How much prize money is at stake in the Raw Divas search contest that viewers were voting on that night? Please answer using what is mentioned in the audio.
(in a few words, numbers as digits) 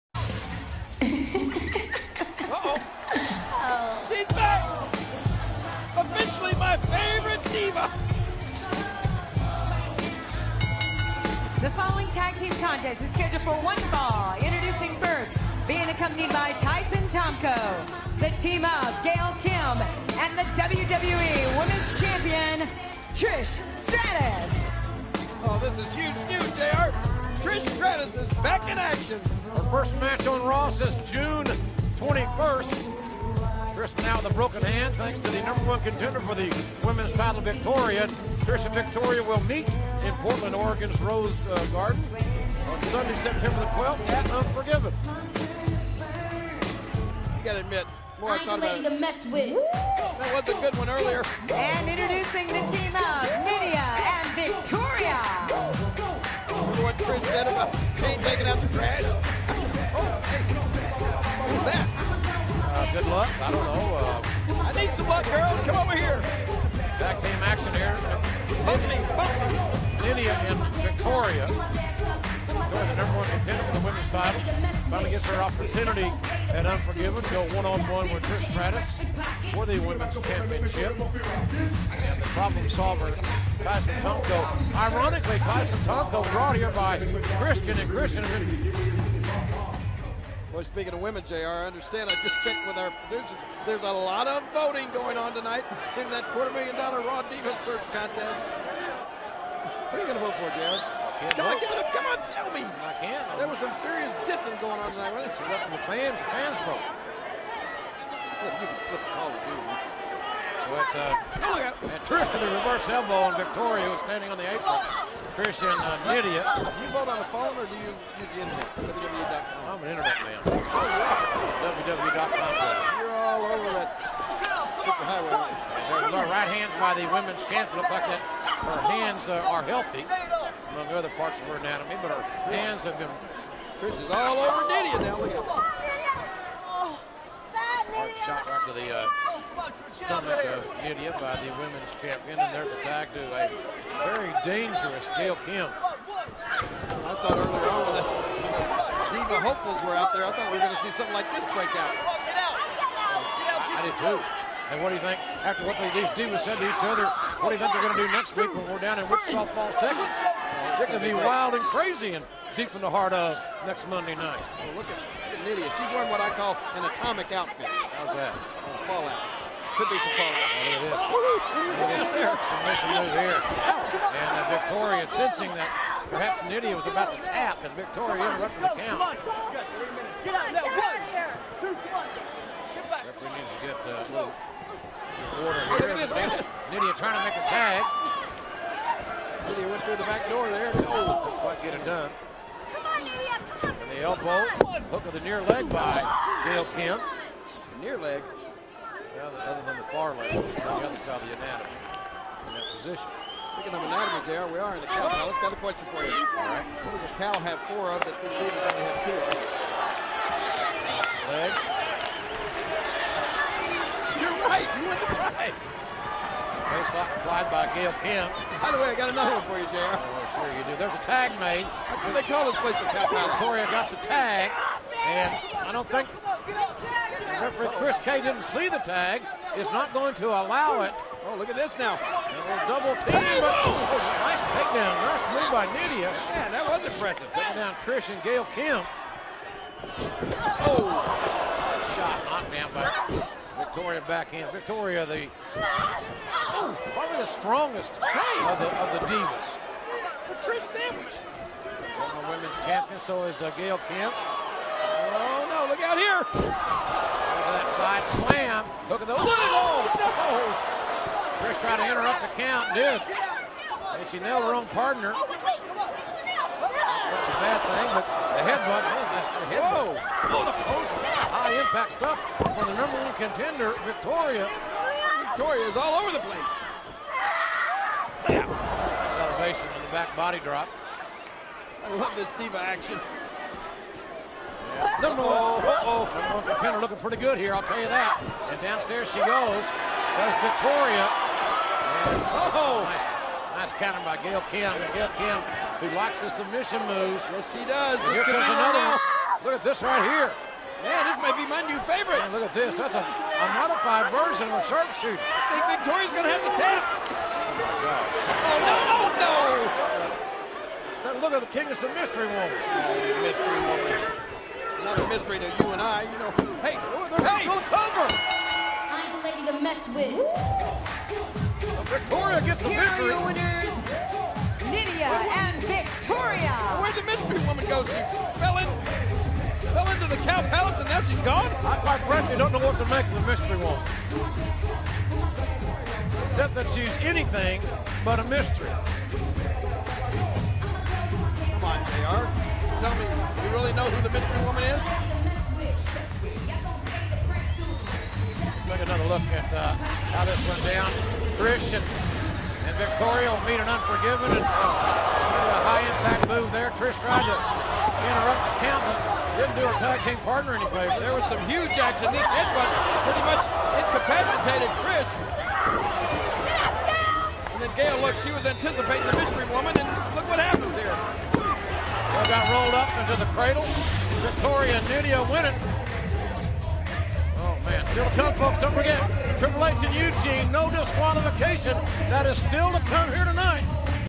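quarter million dollar.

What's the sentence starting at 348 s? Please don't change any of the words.
Take another look at uh, how this went down.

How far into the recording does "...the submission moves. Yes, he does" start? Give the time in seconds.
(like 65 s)
296 s.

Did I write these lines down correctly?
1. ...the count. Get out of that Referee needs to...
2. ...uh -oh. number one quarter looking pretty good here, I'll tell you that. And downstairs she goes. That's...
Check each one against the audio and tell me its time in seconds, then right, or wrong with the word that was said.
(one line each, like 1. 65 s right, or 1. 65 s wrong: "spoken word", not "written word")
1. 178 s right
2. 285 s wrong: "contender", not "quarter".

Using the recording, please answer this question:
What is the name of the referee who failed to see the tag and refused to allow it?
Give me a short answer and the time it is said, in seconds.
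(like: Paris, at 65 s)
Chris K, at 227 s.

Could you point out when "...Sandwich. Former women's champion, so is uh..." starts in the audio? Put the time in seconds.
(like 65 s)
250 s.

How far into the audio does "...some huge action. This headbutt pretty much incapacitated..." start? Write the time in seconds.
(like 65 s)
361 s.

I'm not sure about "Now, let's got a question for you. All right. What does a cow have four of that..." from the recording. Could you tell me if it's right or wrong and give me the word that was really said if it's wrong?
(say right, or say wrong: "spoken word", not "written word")
right.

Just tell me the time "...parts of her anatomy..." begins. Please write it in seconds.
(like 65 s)
131 s.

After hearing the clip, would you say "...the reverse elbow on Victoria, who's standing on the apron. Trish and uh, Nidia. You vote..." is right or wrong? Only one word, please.
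right.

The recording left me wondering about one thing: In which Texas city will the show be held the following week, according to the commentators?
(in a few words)
Wichita Falls.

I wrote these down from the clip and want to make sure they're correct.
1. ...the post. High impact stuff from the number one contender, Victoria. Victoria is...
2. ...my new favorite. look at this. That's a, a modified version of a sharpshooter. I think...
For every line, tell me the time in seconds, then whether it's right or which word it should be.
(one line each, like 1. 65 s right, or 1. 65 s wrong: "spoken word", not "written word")
1. 270 s right
2. 301 s right.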